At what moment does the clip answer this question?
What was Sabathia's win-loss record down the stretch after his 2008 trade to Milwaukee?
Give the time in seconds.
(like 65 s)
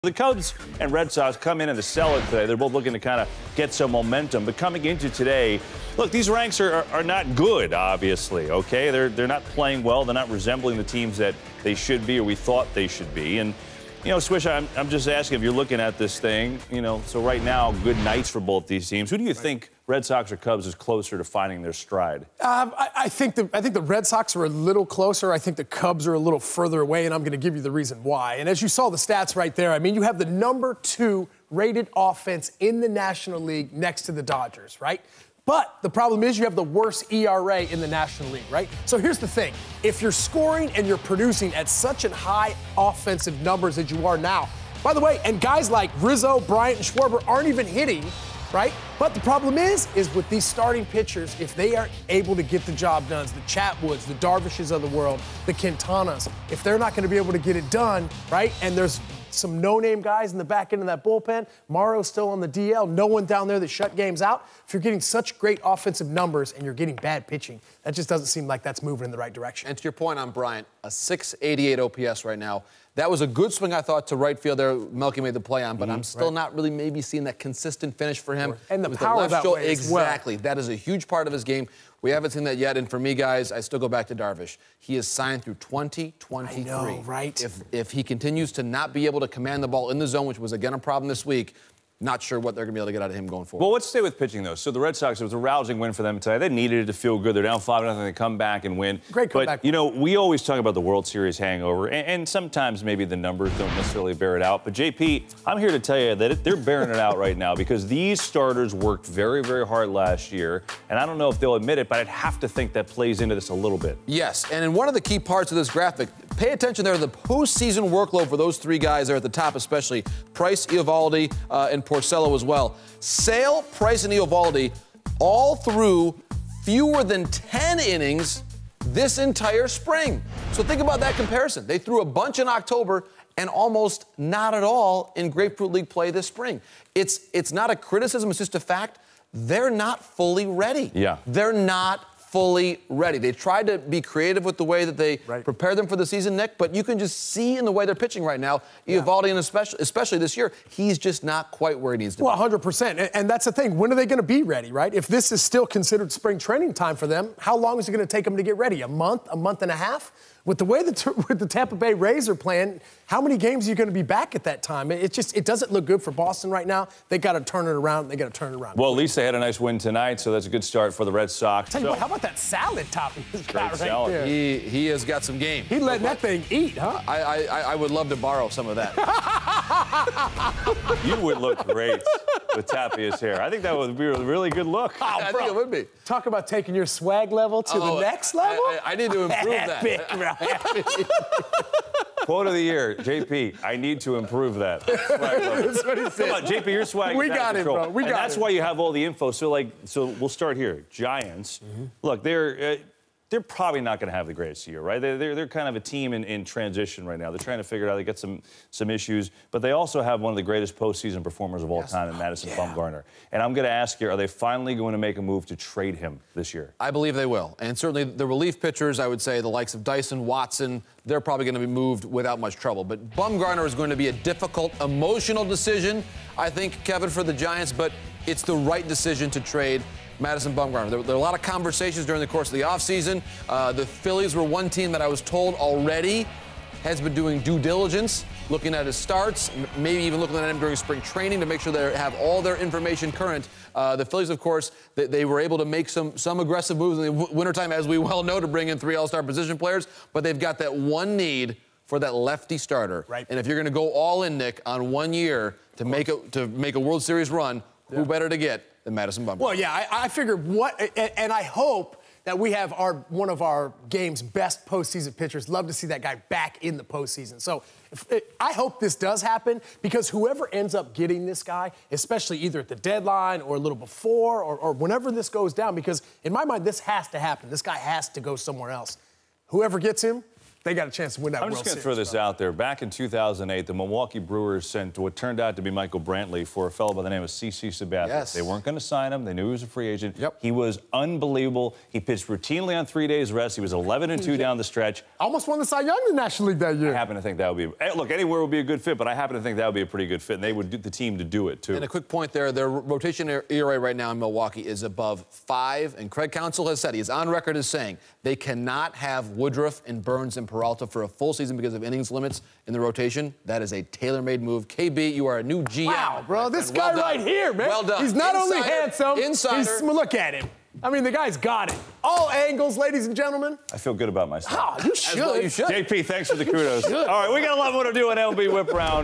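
293 s.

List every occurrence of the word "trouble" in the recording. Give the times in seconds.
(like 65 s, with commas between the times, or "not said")
222 s.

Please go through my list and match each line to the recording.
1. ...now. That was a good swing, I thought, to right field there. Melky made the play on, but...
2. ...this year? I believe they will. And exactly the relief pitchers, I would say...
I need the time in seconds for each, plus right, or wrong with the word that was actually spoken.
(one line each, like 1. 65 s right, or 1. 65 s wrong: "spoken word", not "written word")
1. 72 s right
2. 216 s wrong: "certainly", not "exactly".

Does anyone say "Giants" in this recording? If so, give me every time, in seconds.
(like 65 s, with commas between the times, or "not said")
200 s, 227 s.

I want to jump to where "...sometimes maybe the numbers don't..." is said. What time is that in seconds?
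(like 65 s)
102 s.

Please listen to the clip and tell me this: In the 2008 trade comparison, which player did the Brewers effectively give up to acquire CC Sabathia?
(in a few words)
Michael Brantley.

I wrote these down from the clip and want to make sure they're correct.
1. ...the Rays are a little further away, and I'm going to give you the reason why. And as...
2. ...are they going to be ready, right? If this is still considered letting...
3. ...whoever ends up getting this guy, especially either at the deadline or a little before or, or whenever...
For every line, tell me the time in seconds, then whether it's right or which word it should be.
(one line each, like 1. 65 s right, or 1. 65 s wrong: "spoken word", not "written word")
1. 25 s wrong: "Cubs", not "Rays"
2. 153 s wrong: "spring", not "letting"
3. 270 s right.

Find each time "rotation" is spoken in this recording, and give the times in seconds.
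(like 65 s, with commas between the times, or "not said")
302 s, 312 s.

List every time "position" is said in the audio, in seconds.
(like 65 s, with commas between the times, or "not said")
249 s.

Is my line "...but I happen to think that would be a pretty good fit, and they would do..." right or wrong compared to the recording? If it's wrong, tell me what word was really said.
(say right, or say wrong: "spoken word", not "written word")
right.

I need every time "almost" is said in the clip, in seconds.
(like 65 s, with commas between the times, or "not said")
133 s, 295 s.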